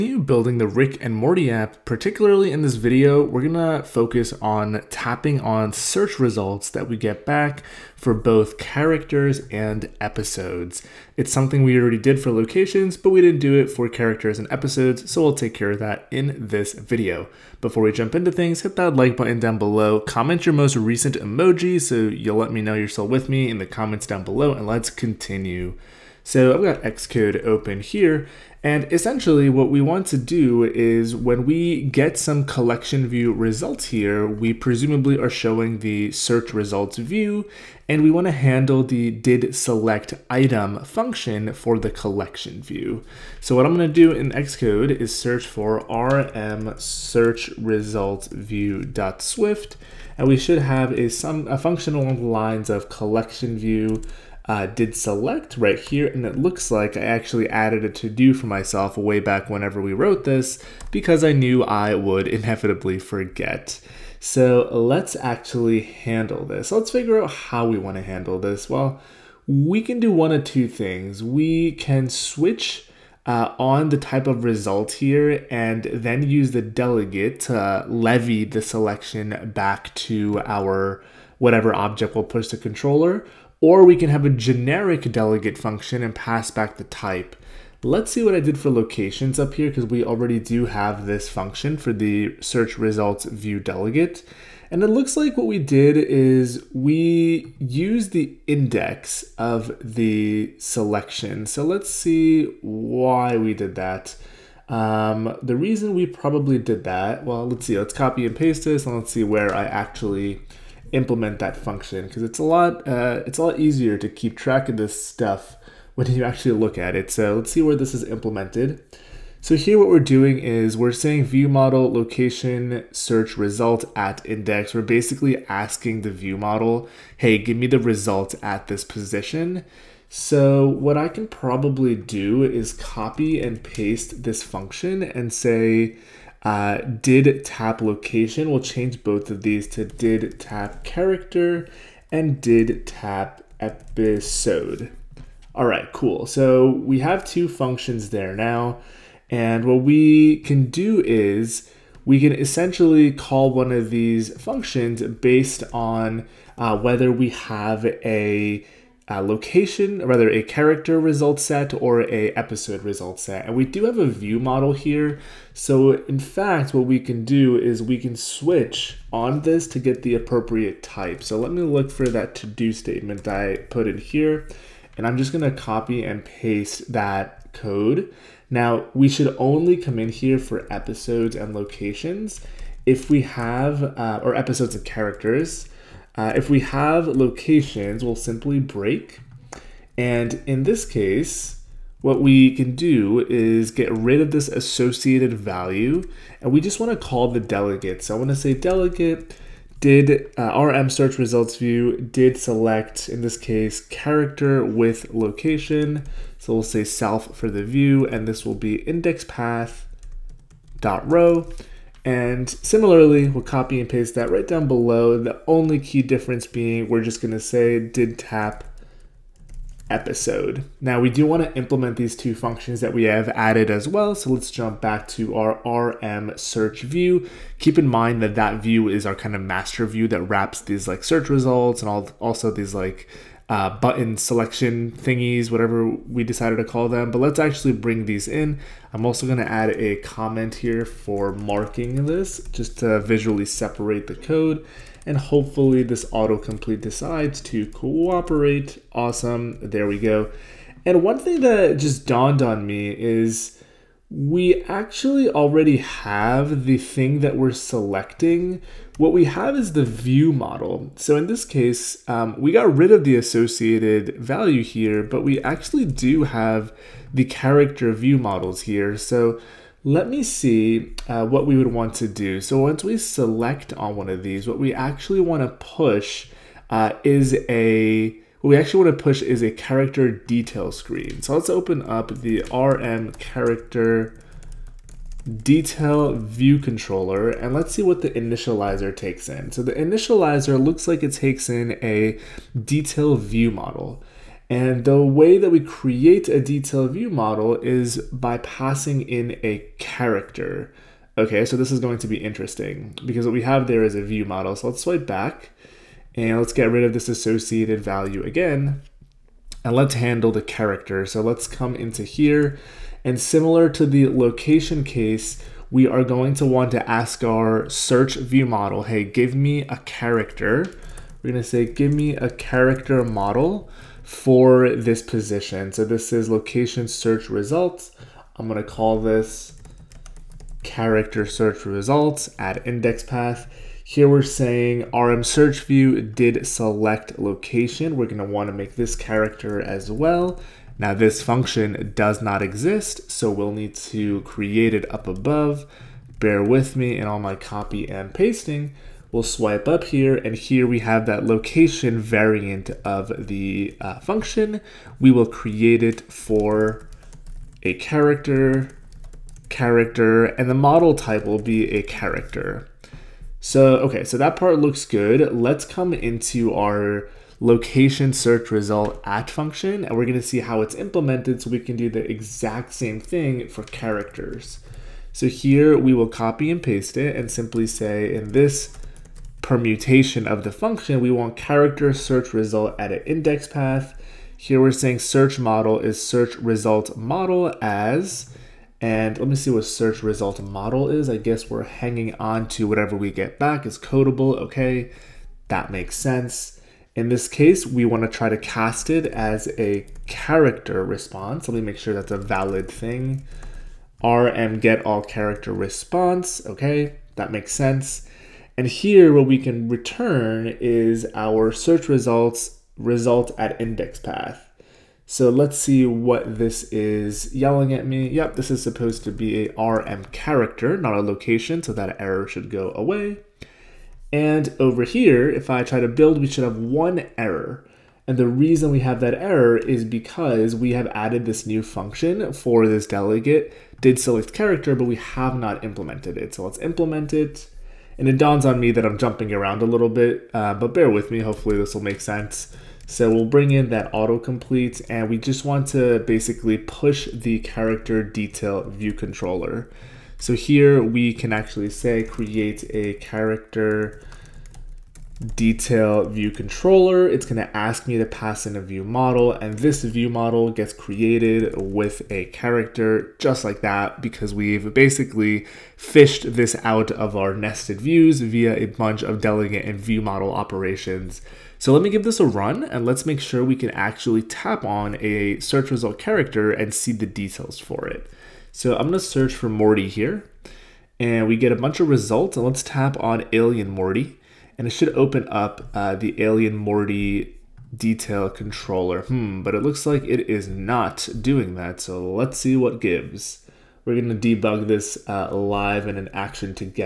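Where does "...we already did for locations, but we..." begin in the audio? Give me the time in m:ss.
0:11.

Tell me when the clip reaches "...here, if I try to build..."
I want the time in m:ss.
7:04.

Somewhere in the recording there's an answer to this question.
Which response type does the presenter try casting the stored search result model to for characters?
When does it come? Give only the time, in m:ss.
6:44.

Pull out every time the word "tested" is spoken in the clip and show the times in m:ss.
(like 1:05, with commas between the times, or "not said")
not said.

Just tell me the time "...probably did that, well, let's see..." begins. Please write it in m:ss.
1:46.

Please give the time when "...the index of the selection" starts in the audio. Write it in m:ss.
1:38.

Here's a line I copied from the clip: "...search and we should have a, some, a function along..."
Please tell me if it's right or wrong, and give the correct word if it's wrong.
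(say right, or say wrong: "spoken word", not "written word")
right.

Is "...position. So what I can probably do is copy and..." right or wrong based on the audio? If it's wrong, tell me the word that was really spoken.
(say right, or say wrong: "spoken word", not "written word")
right.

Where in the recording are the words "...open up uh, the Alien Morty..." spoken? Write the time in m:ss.
8:04.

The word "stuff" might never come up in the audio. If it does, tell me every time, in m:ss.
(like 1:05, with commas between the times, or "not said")
1:55.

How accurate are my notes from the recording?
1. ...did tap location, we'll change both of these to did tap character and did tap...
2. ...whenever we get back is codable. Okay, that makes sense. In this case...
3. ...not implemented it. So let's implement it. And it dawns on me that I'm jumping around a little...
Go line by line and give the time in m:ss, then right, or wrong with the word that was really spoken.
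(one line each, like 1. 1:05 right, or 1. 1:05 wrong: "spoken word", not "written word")
1. 2:17 right
2. 6:32 wrong: "whatever", not "whenever"
3. 7:15 right.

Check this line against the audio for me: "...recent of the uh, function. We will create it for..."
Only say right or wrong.
wrong.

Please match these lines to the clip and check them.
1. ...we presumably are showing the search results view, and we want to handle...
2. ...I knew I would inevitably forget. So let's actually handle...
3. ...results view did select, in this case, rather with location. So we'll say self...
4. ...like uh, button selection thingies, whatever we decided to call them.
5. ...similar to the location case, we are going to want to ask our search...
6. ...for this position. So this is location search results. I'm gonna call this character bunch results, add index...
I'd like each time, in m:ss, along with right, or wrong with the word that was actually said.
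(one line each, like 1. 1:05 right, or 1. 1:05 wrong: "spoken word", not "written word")
1. 0:34 right
2. 1:01 right
3. 3:21 wrong: "character", not "rather"
4. 3:52 right
5. 5:13 right
6. 5:24 wrong: "search", not "bunch".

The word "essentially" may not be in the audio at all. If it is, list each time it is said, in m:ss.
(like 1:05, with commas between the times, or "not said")
0:28, 2:32.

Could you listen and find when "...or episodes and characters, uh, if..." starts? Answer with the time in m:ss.
3:04.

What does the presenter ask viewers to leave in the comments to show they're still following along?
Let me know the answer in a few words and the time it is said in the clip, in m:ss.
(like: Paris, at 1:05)
most recent emoji, at 0:20.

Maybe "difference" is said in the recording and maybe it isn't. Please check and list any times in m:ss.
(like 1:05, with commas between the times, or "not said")
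3:36.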